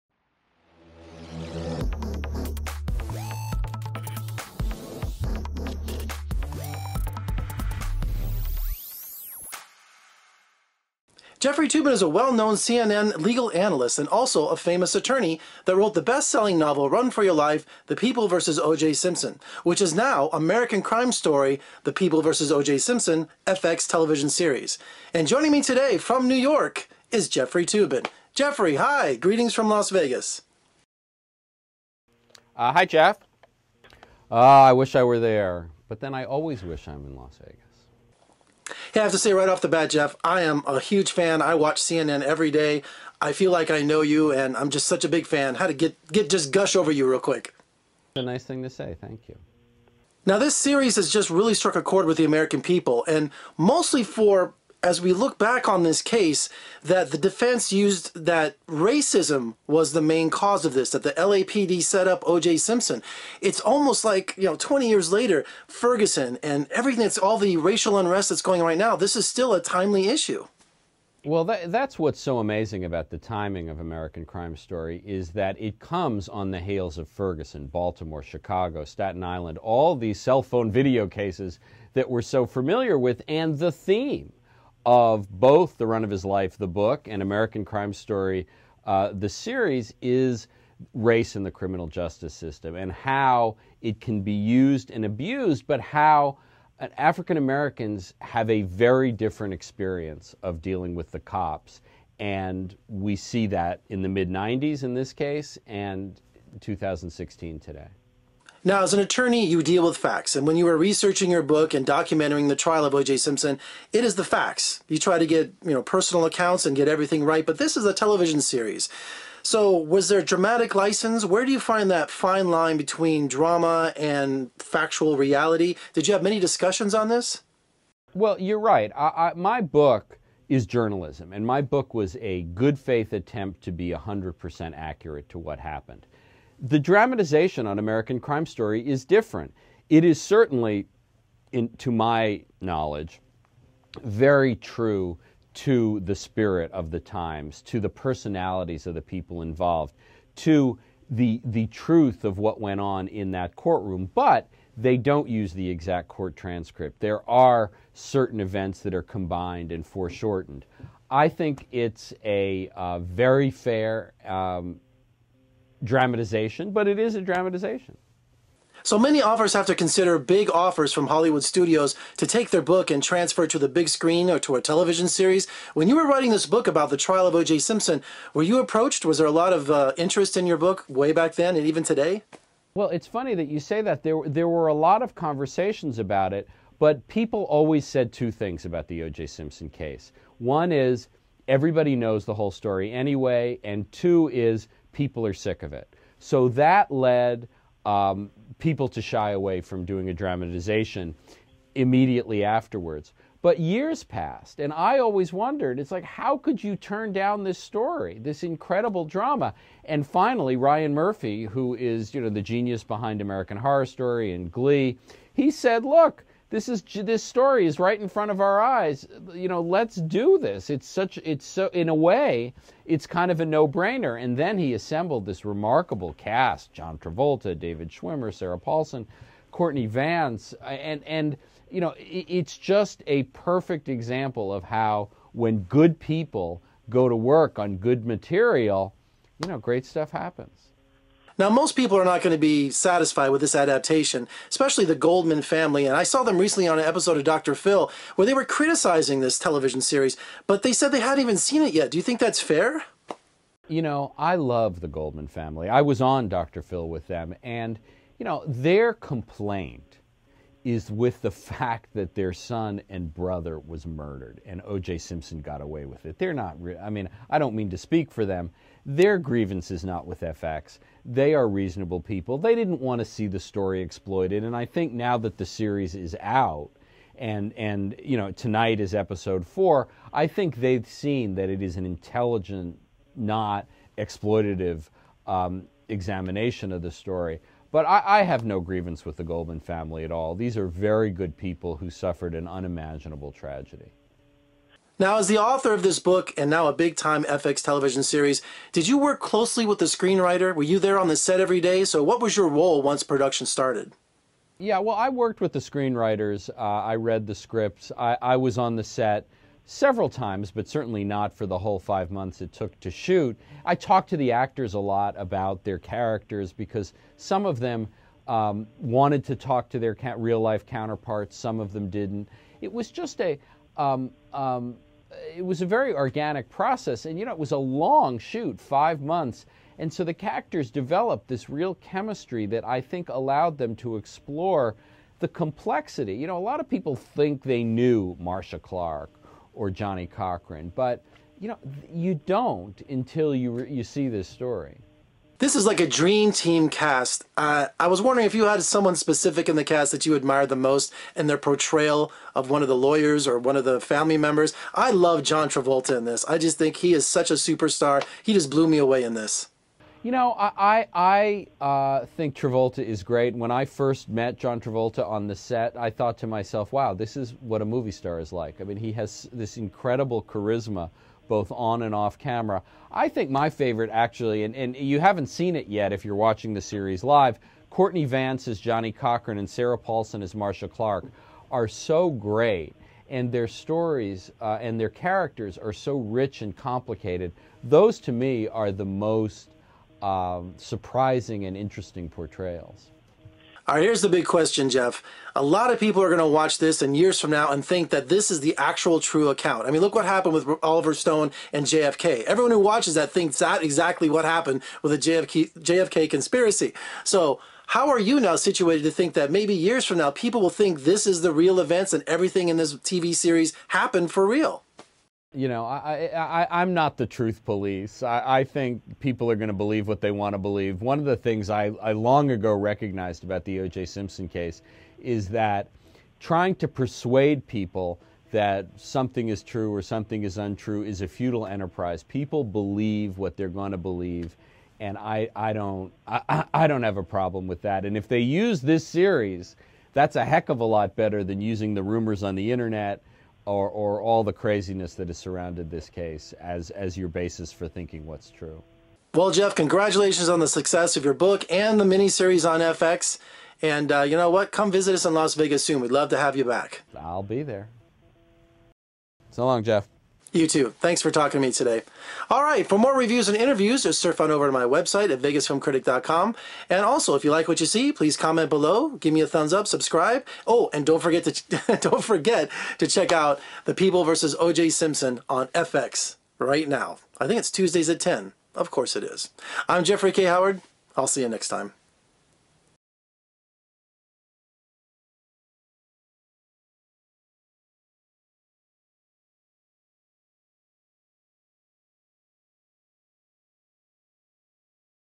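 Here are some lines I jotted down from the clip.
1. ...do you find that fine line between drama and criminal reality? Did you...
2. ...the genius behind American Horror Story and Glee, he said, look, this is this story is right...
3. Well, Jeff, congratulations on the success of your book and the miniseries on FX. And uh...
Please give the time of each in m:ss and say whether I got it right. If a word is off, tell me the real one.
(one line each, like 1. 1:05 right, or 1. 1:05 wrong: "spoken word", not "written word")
1. 2:01 wrong: "factual", not "criminal"
2. 3:32 right
3. 7:29 right.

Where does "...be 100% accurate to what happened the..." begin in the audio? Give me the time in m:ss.
2:13.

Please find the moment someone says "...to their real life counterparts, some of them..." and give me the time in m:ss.
5:19.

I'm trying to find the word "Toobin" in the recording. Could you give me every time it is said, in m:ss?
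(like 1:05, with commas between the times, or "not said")
0:11, 0:27.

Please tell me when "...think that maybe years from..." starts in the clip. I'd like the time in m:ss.
6:48.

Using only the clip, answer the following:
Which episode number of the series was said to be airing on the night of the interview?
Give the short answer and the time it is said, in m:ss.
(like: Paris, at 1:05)
4, at 4:38.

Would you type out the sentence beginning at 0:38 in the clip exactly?
Hey, I have to say right off the bat, Jeff, I am a huge fan.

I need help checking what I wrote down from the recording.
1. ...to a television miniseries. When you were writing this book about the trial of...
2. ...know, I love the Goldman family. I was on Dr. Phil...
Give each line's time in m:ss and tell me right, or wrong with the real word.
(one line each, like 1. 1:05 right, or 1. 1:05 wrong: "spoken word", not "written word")
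1. 2:54 wrong: "series", not "miniseries"
2. 4:13 right.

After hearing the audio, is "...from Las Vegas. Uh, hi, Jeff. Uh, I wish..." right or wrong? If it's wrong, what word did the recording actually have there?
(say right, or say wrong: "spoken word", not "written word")
right.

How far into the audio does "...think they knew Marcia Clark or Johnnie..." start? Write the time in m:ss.
5:36.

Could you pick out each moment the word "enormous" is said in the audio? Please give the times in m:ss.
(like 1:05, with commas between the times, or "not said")
not said.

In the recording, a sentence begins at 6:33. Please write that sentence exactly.
All right, here's the big question, Jeff.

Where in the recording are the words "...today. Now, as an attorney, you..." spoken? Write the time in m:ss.
1:47.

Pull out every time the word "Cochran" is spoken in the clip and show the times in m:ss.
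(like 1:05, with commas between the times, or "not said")
5:40, 6:18.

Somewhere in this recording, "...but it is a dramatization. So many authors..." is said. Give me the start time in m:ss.
2:46.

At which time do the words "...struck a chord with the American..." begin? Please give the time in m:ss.
0:51.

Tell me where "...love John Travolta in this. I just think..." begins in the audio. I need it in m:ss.
5:54.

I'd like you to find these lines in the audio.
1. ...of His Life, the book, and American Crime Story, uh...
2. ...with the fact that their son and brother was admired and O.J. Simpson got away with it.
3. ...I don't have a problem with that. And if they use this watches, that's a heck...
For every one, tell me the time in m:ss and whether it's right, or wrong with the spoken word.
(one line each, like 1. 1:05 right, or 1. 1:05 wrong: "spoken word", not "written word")
1. 1:26 right
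2. 4:20 wrong: "murdered", not "admired"
3. 7:16 wrong: "series", not "watches".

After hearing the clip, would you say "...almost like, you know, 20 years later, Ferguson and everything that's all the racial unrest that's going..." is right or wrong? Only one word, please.
right.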